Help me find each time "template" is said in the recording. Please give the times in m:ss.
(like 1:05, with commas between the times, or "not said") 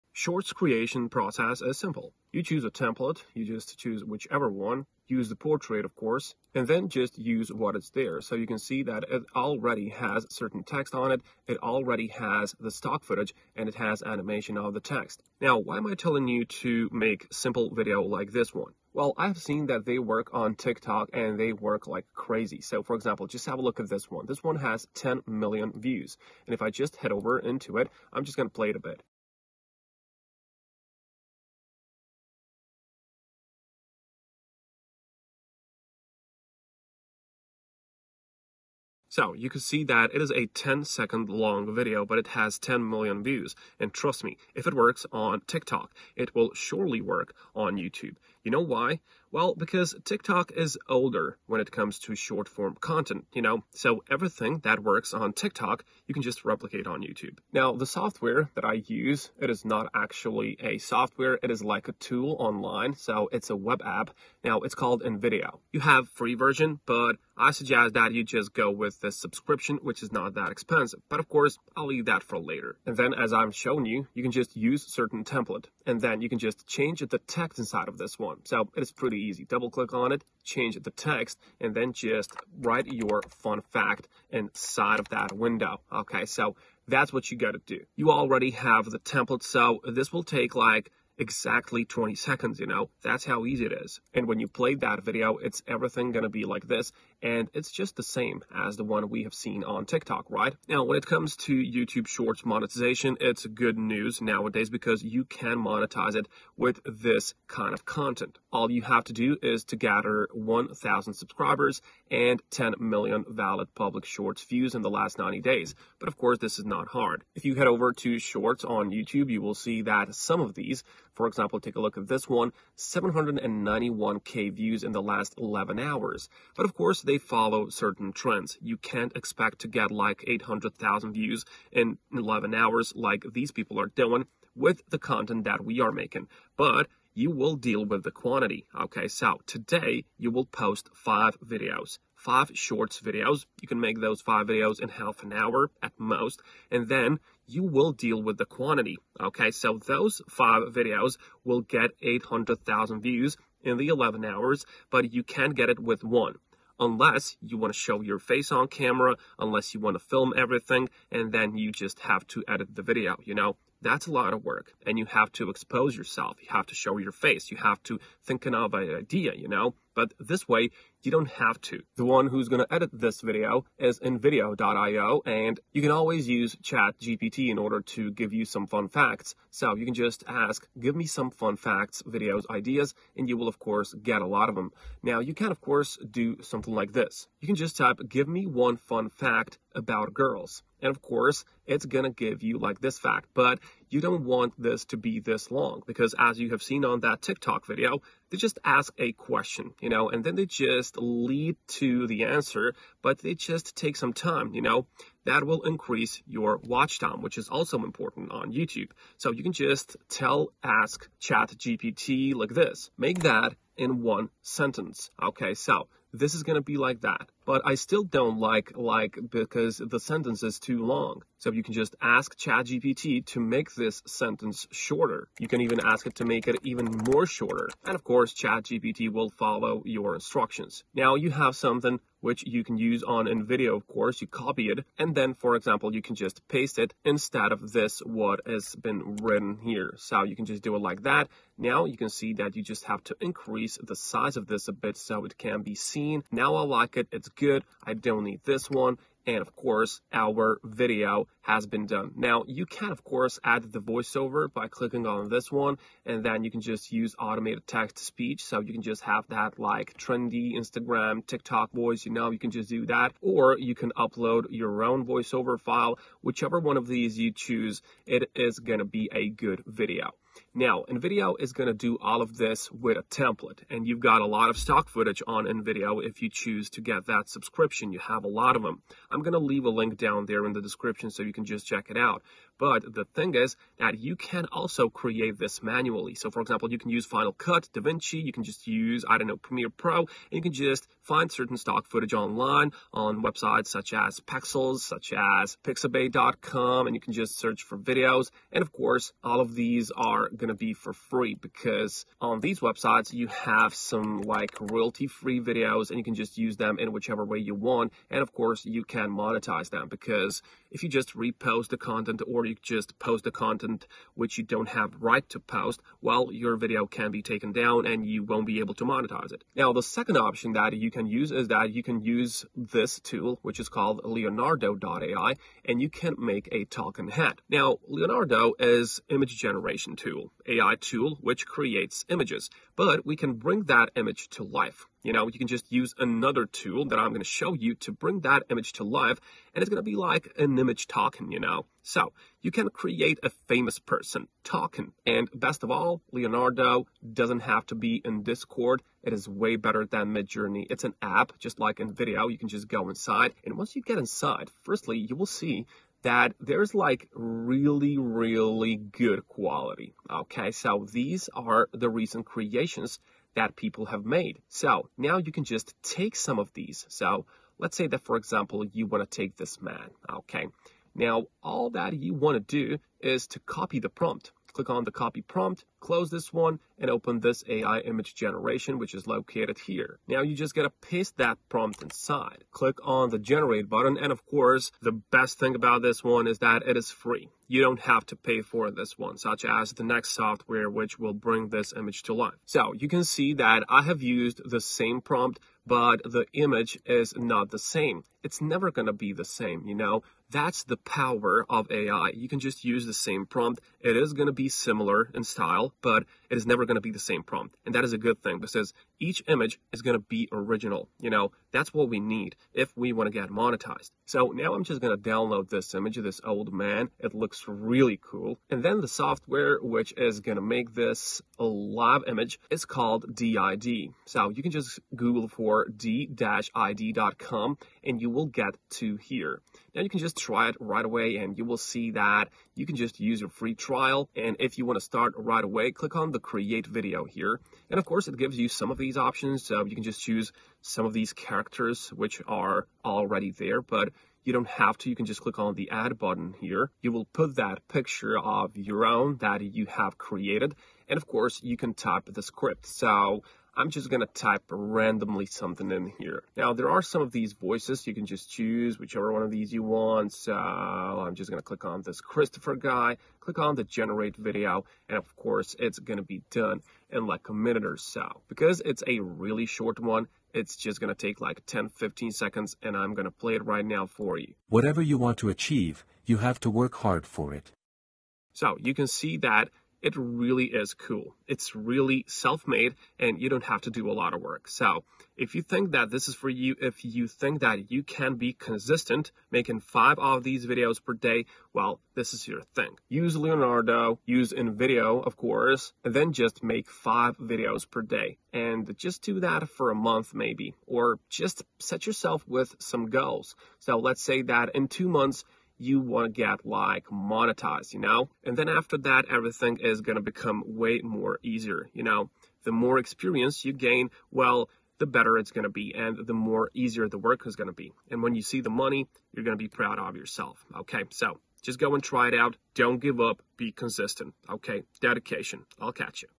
0:02, 1:15, 1:28, 4:33.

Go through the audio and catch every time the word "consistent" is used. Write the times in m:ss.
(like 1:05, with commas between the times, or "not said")
8:08, 8:43.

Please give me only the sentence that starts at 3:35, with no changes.
Okay, so this is going to be like that.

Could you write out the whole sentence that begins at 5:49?
It is way better than Midjourney.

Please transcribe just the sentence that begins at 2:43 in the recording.
That's a lot of work, and you have to expose yourself.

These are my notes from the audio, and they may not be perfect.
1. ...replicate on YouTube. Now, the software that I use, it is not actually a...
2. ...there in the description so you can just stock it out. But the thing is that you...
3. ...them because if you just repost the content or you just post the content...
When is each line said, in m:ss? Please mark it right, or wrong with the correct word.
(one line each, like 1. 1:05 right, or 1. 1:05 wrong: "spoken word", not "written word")
1. 0:56 right
2. 4:40 wrong: "check", not "stock"
3. 5:09 right.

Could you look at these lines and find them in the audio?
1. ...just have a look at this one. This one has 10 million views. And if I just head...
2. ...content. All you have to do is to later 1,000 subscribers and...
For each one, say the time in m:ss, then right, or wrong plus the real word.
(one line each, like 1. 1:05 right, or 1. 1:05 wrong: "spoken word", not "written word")
1. 0:23 right
2. 1:47 wrong: "gather", not "later".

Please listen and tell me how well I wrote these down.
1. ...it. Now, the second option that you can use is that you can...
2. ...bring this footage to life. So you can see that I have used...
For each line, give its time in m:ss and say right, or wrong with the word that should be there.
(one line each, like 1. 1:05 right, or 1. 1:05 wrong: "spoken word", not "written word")
1. 5:19 right
2. 6:31 wrong: "image", not "footage".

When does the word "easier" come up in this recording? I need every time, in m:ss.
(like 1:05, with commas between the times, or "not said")
8:31, 8:36.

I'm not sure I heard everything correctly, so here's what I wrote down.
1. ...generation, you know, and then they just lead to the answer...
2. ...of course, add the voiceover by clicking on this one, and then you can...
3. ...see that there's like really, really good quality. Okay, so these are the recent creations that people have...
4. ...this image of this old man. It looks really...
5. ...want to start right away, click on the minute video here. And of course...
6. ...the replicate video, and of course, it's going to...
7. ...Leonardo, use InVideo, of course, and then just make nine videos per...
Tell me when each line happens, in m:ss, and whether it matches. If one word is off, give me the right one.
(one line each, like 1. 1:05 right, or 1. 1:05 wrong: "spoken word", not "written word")
1. 3:19 wrong: "question", not "generation"
2. 4:12 right
3. 5:55 right
4. 6:55 right
5. 7:14 wrong: "create", not "minute"
6. 7:43 wrong: "generate", not "replicate"
7. 8:13 wrong: "five", not "nine".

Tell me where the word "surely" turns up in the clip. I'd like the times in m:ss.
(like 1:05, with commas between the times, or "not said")
0:46.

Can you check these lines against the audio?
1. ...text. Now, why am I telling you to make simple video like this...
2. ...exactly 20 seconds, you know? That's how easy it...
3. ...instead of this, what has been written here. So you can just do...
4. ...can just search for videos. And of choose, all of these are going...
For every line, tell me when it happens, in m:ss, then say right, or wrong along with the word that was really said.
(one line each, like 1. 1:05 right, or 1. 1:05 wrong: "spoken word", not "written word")
1. 0:14 right
2. 1:31 right
3. 3:57 right
4. 4:56 wrong: "course", not "choose".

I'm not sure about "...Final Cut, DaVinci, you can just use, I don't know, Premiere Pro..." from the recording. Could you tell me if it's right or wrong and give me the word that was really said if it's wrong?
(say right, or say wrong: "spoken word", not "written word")
right.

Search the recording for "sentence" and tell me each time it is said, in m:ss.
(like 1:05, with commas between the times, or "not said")
3:34, 3:39, 3:44.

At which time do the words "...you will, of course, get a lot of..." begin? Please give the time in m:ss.
3:03.